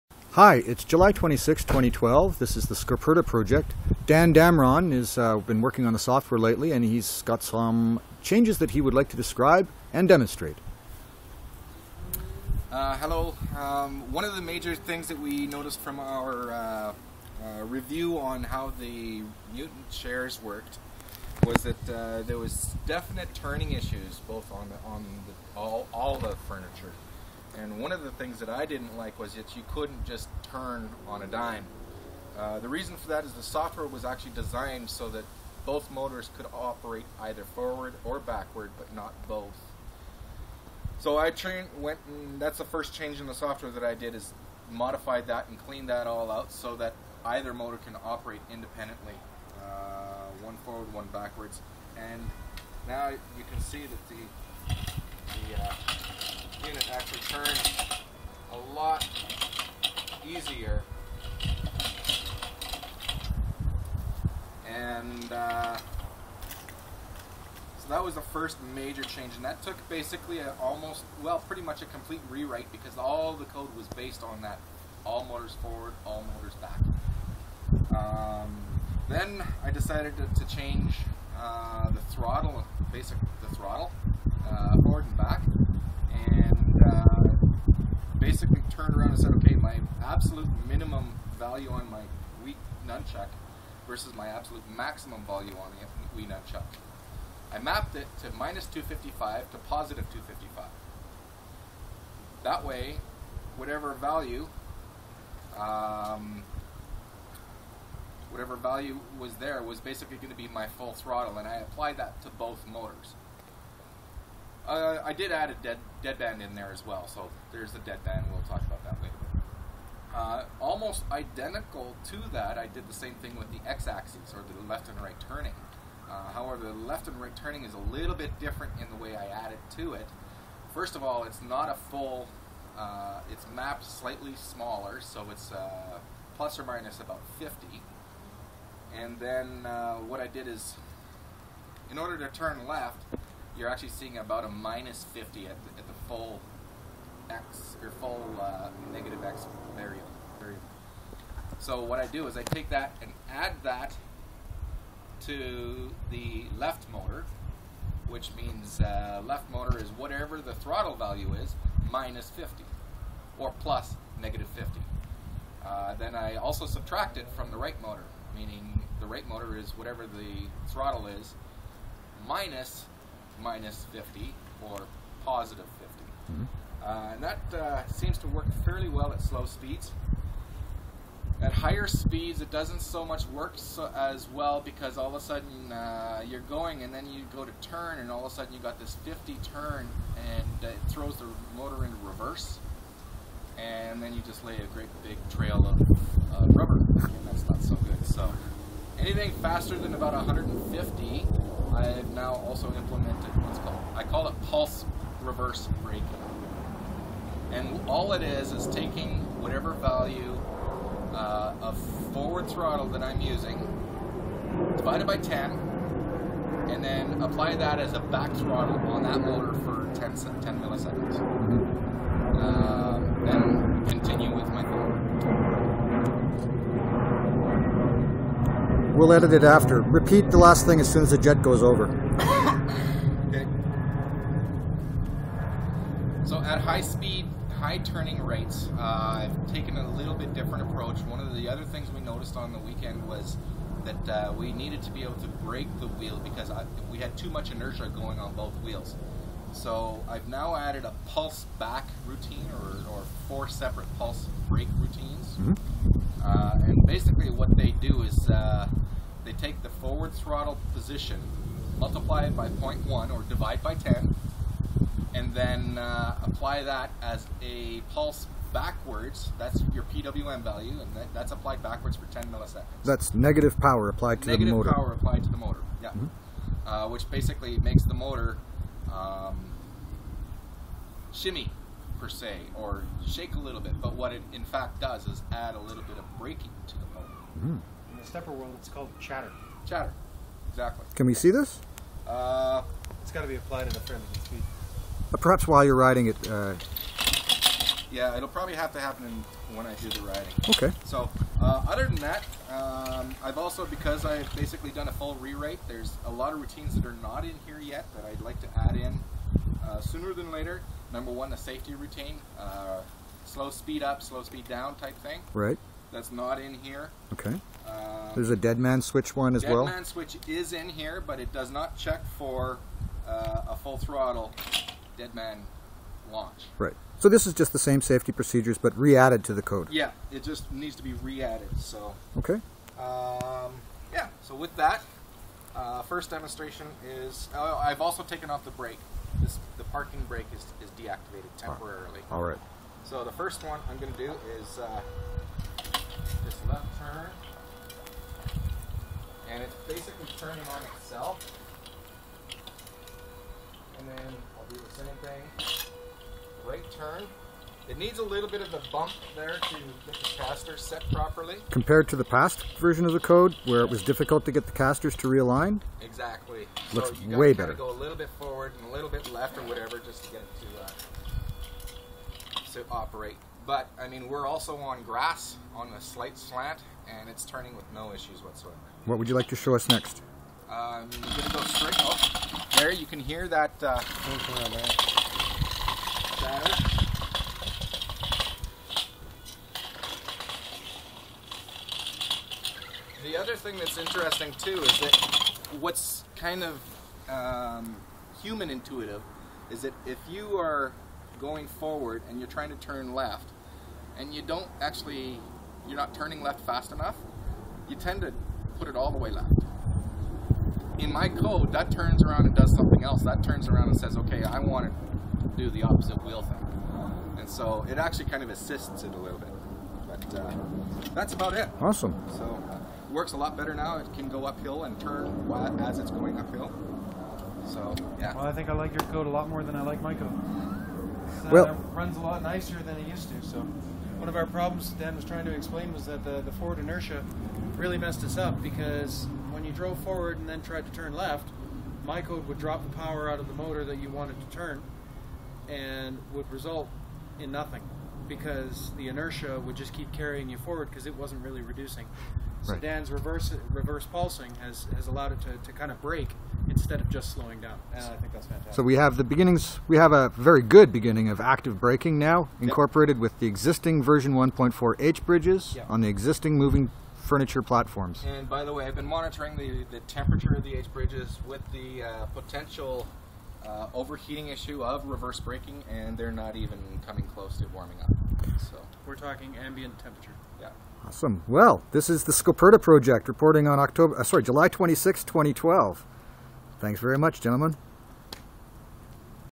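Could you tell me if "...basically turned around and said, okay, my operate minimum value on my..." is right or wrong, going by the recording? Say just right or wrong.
wrong.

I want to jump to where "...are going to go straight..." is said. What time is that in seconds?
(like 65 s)
380 s.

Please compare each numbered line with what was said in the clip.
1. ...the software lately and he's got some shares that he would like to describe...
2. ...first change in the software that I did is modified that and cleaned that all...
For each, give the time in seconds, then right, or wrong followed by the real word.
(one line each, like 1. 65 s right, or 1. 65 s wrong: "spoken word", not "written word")
1. 5 s wrong: "changes", not "shares"
2. 42 s right.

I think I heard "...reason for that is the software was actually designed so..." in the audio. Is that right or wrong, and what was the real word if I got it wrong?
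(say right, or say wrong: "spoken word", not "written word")
right.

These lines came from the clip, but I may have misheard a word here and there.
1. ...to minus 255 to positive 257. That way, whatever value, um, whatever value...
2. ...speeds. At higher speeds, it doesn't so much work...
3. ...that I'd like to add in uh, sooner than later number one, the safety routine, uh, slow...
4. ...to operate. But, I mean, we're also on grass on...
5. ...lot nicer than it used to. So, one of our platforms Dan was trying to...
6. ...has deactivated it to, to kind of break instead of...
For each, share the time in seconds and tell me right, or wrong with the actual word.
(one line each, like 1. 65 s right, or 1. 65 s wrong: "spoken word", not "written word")
1. 98 s wrong: "255", not "257"
2. 179 s right
3. 307 s right
4. 372 s right
5. 432 s wrong: "problems", not "platforms"
6. 454 s wrong: "allowed", not "deactivated".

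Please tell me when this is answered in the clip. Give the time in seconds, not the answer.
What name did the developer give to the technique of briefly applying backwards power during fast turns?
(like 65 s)
204 s.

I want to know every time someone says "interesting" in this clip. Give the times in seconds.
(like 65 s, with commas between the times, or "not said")
393 s.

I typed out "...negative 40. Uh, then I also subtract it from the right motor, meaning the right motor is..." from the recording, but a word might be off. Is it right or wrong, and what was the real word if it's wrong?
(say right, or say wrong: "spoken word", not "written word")
wrong: "50", not "40".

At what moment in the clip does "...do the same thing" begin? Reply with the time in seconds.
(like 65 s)
354 s.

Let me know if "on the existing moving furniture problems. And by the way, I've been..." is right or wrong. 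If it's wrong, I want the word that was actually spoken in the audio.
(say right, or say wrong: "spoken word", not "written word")
wrong: "platforms", not "problems".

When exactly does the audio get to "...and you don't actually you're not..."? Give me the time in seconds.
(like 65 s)
403 s.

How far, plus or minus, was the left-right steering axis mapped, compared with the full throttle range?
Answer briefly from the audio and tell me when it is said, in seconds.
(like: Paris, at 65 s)
50, at 136 s.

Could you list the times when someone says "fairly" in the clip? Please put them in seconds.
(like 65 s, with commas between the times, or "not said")
178 s, 293 s.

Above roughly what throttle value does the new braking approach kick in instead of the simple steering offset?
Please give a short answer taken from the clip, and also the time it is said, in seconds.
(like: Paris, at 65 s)
150, at 199 s.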